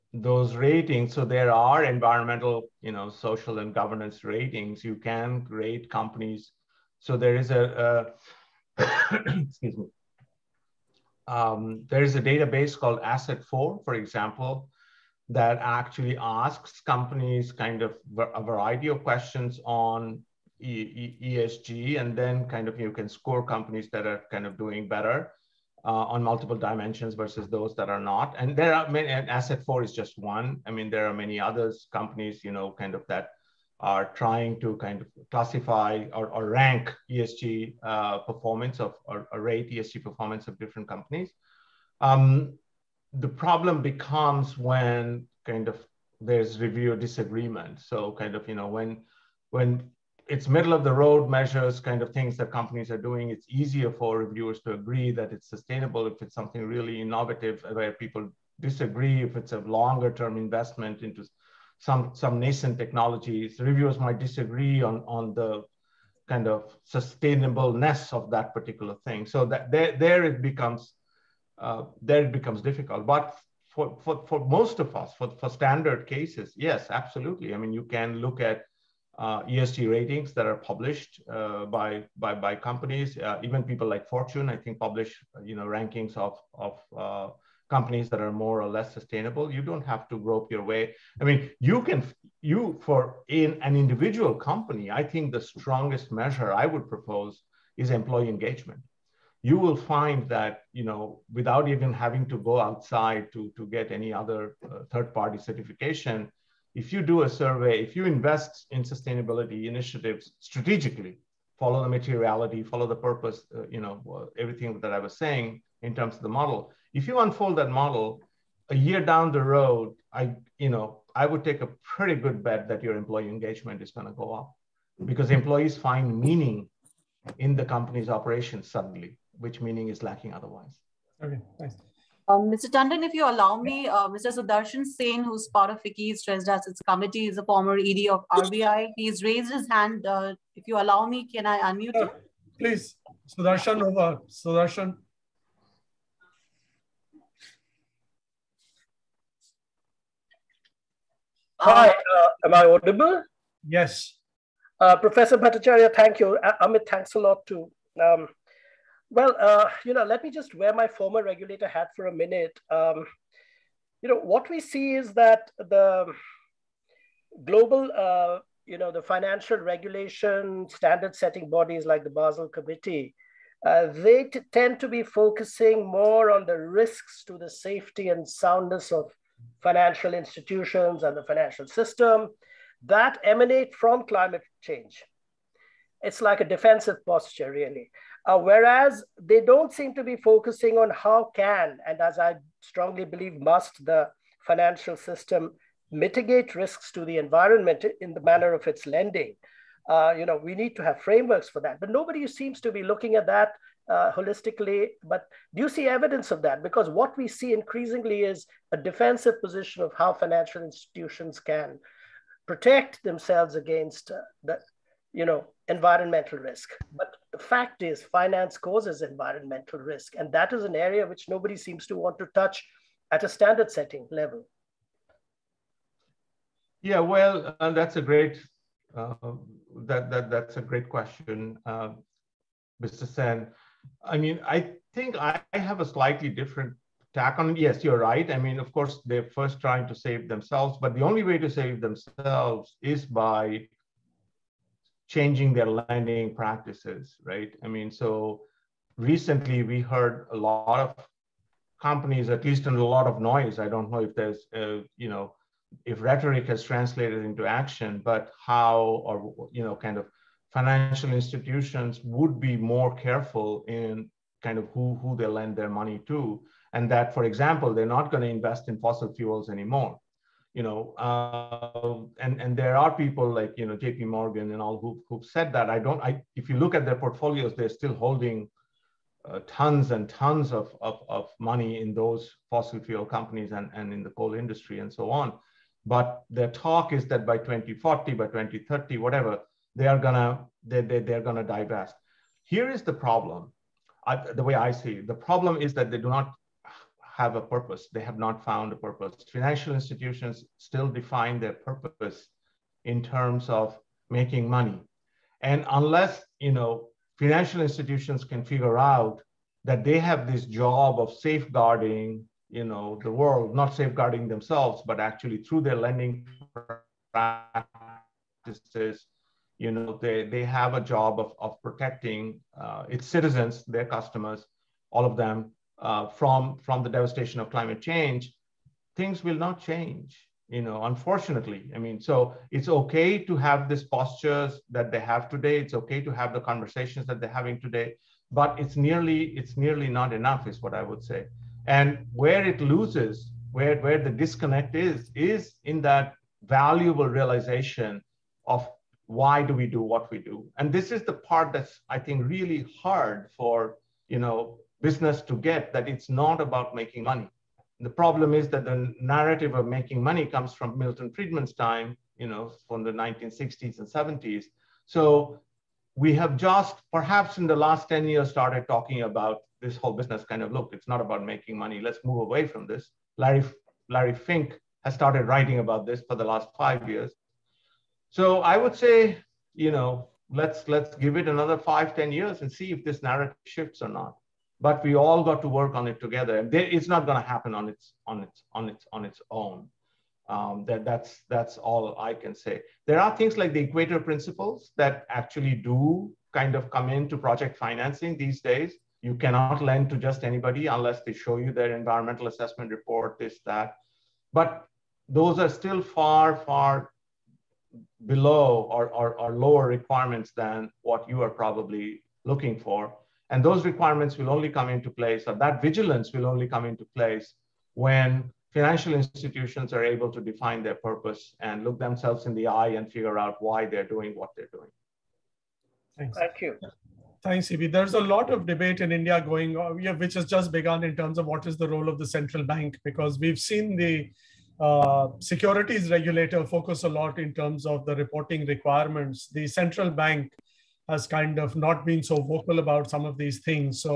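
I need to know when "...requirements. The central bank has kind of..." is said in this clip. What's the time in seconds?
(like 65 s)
438 s.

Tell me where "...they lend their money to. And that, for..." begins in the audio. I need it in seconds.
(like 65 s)
265 s.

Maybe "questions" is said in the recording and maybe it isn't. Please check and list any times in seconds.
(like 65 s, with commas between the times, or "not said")
19 s, 230 s.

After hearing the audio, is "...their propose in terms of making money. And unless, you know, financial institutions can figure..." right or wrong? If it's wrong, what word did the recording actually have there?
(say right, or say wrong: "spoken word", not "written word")
wrong: "purpose", not "propose".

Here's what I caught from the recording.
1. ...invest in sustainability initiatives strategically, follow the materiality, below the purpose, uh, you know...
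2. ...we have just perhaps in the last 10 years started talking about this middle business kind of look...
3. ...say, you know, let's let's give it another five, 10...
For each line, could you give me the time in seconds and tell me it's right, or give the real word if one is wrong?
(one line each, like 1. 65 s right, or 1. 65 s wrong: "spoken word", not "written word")
1. 108 s wrong: "follow", not "below"
2. 365 s wrong: "whole", not "middle"
3. 378 s right.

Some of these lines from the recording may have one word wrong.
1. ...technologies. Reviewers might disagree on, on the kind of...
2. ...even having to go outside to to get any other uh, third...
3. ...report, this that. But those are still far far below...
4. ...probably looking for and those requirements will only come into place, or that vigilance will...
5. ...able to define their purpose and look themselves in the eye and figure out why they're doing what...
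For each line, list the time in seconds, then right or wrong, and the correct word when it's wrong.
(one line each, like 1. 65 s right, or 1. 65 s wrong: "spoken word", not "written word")
1. 62 s right
2. 101 s right
3. 402 s right
4. 411 s right
5. 419 s right.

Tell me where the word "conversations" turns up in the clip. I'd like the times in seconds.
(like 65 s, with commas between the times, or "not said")
336 s.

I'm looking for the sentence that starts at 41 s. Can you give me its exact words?
Um, the problem becomes when kind of there's review disagreement.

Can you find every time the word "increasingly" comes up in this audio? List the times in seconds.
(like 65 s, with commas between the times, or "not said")
207 s.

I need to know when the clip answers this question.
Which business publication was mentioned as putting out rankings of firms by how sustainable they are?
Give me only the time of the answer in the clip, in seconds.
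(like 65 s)
84 s.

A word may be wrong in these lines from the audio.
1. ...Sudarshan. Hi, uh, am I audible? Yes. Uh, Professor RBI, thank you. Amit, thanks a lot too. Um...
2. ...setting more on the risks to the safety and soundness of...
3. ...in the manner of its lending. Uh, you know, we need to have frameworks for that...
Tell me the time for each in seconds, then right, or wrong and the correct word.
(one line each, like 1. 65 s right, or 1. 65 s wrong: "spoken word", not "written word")
1. 144 s wrong: "Bhattacharya", not "RBI"
2. 175 s wrong: "focusing", not "setting"
3. 198 s right.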